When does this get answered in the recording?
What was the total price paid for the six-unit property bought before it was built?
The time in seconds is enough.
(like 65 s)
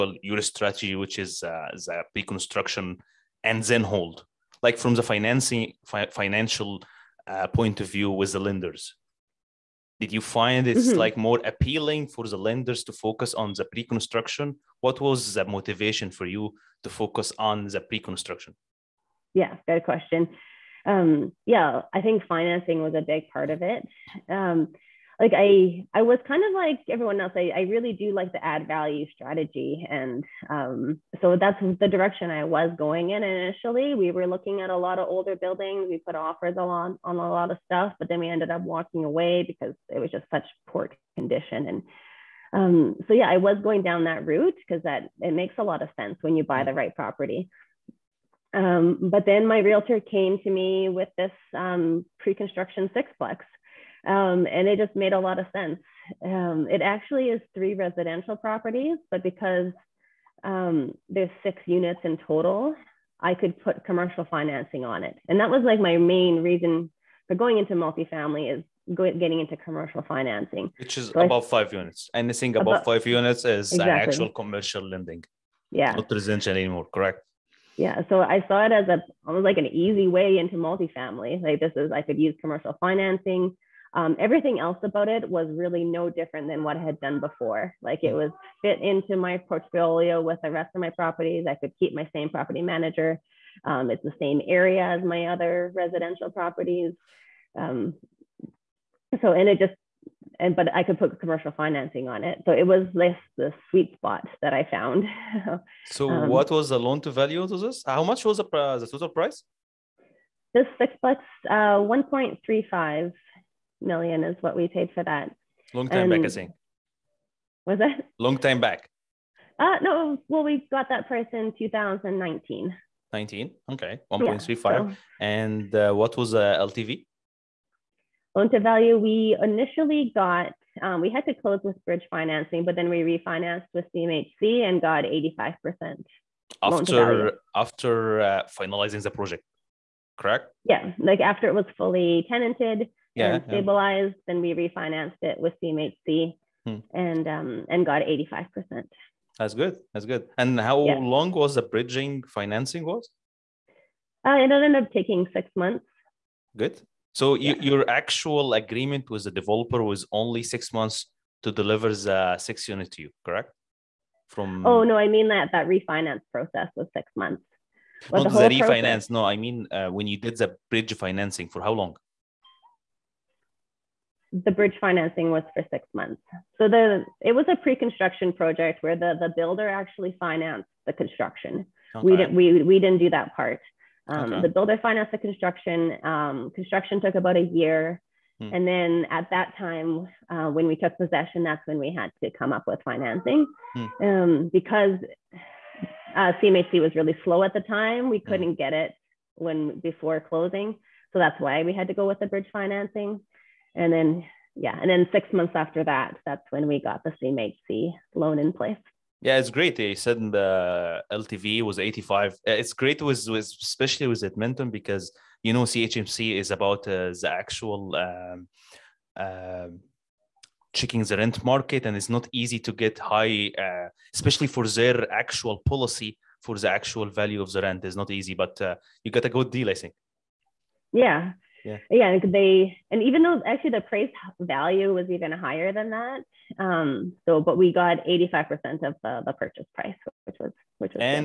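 111 s.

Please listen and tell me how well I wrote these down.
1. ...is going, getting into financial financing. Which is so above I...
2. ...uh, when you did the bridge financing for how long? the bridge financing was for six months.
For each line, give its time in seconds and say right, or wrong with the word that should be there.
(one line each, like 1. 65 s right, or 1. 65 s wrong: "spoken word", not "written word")
1. 68 s wrong: "commercial", not "financial"
2. 169 s right.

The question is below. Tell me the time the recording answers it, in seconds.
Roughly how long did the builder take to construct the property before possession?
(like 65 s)
187 s.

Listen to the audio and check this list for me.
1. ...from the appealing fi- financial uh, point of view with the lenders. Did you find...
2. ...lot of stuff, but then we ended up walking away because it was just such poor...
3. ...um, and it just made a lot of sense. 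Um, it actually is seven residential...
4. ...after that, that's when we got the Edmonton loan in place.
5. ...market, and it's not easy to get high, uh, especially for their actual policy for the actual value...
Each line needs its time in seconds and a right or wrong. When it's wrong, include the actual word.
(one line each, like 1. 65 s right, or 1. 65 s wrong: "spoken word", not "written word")
1. 4 s wrong: "financing", not "appealing"
2. 37 s right
3. 54 s wrong: "three", not "seven"
4. 205 s wrong: "CMHC", not "Edmonton"
5. 221 s right.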